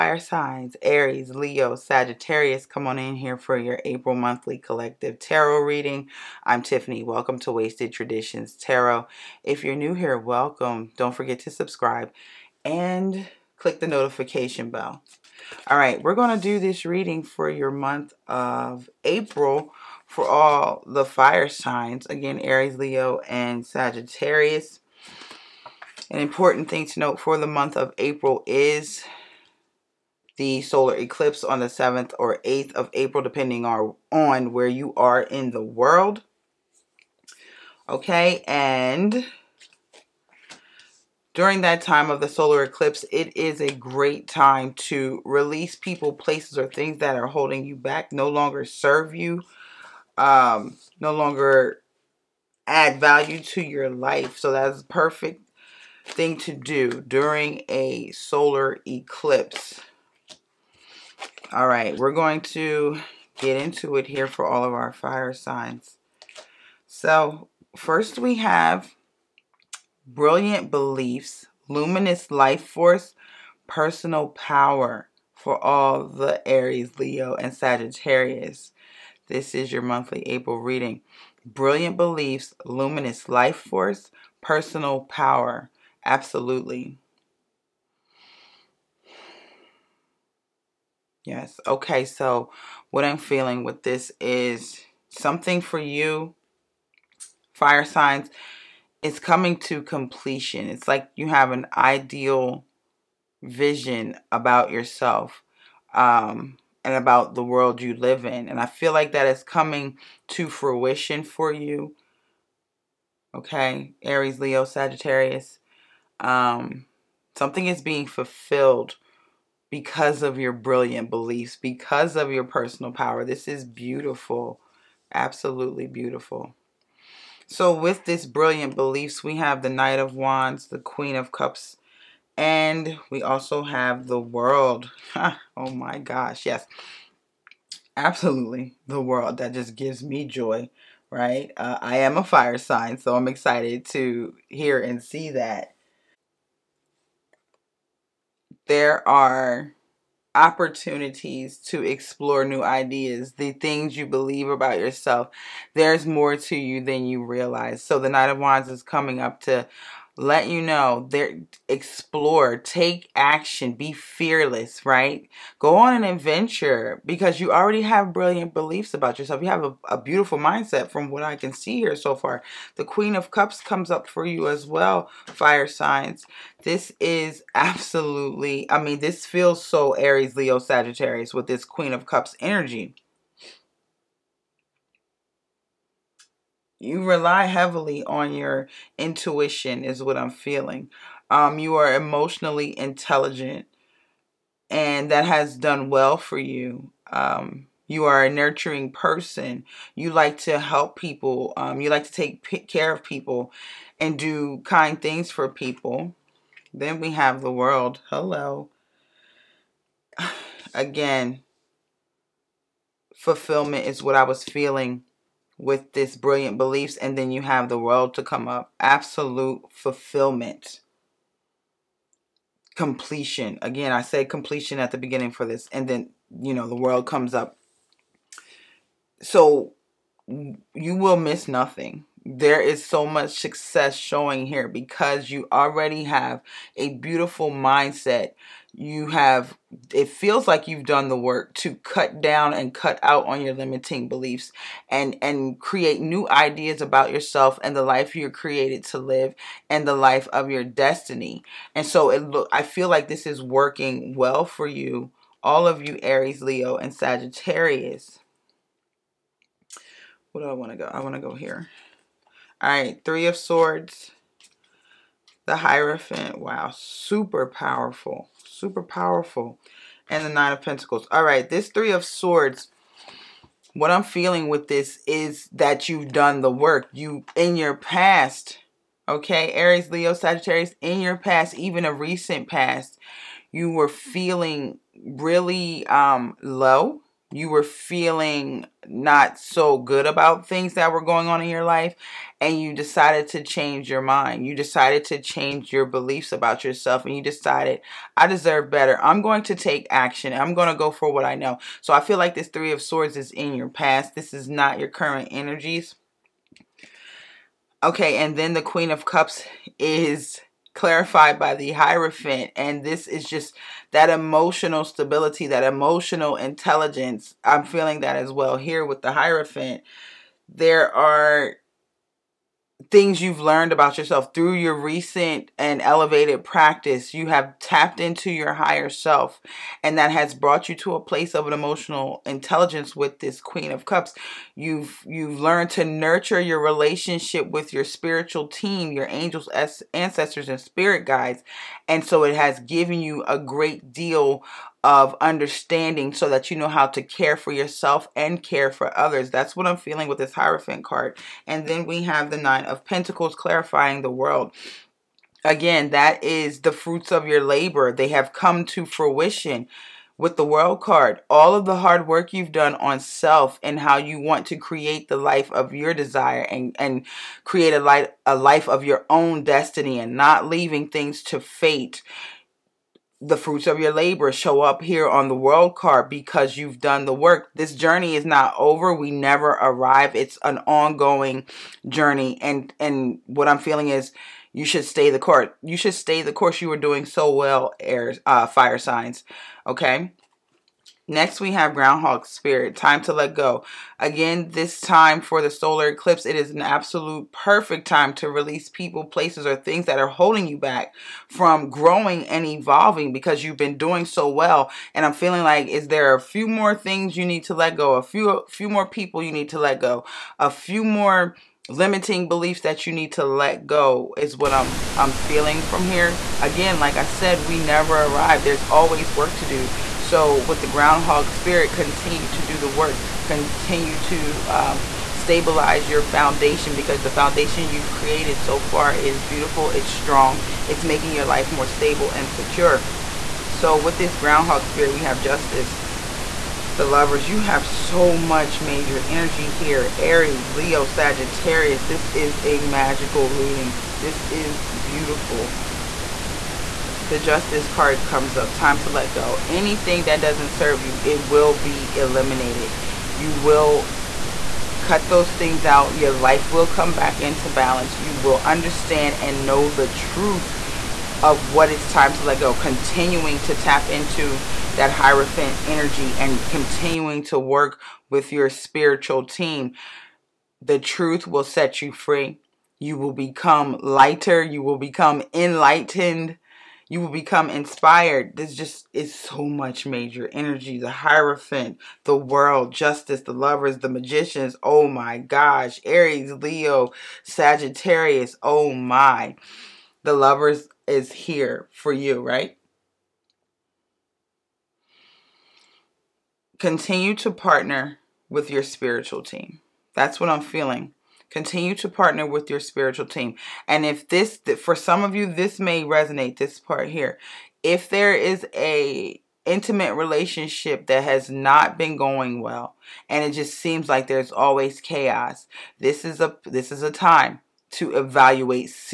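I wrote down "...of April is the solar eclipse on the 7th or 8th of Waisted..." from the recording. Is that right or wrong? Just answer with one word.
wrong.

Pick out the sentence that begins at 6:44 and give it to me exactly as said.
And I'm feeling like, is there a few more things you need to let go?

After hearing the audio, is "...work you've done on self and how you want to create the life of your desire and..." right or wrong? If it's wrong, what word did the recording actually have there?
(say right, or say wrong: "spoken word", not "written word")
right.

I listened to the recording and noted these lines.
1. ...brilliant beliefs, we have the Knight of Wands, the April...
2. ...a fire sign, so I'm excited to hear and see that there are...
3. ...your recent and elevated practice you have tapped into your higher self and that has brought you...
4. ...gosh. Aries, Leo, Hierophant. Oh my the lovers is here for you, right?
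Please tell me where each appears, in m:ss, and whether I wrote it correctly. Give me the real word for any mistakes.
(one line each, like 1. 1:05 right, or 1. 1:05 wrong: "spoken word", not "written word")
1. 2:08 wrong: "Queen", not "April"
2. 2:22 right
3. 5:24 right
4. 8:05 wrong: "Sagittarius", not "Hierophant".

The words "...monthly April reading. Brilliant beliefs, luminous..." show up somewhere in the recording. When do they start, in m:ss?
1:19.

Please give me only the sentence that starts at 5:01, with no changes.
So I feel like this Three of Swords is in your past.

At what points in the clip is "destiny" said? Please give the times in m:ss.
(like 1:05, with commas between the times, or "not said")
4:10, 6:09.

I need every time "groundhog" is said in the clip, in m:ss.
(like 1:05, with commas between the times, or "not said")
6:31, 7:00, 7:14.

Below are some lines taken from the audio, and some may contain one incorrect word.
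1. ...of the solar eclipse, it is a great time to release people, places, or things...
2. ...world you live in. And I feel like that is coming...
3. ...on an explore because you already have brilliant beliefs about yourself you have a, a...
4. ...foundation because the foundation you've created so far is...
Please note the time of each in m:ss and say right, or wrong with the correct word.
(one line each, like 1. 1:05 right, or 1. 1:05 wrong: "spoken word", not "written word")
1. 0:42 right
2. 1:47 right
3. 2:45 wrong: "adventure", not "explore"
4. 7:06 right.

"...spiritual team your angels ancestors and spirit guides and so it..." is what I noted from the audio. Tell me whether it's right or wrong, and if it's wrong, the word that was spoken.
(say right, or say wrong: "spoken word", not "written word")
right.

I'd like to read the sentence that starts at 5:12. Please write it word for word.
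And this is just that emotional stability, that emotional intelligence.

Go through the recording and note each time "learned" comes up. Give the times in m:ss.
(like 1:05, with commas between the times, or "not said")
5:23, 5:35.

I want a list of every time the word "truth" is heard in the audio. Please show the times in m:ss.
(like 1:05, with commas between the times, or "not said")
7:39, 7:50.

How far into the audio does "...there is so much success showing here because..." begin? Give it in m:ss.
3:52.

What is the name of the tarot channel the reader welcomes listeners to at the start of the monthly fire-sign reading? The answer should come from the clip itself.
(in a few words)
Waisted Traditions Tarot.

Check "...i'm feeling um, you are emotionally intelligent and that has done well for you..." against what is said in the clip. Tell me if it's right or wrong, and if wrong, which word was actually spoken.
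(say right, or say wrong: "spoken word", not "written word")
right.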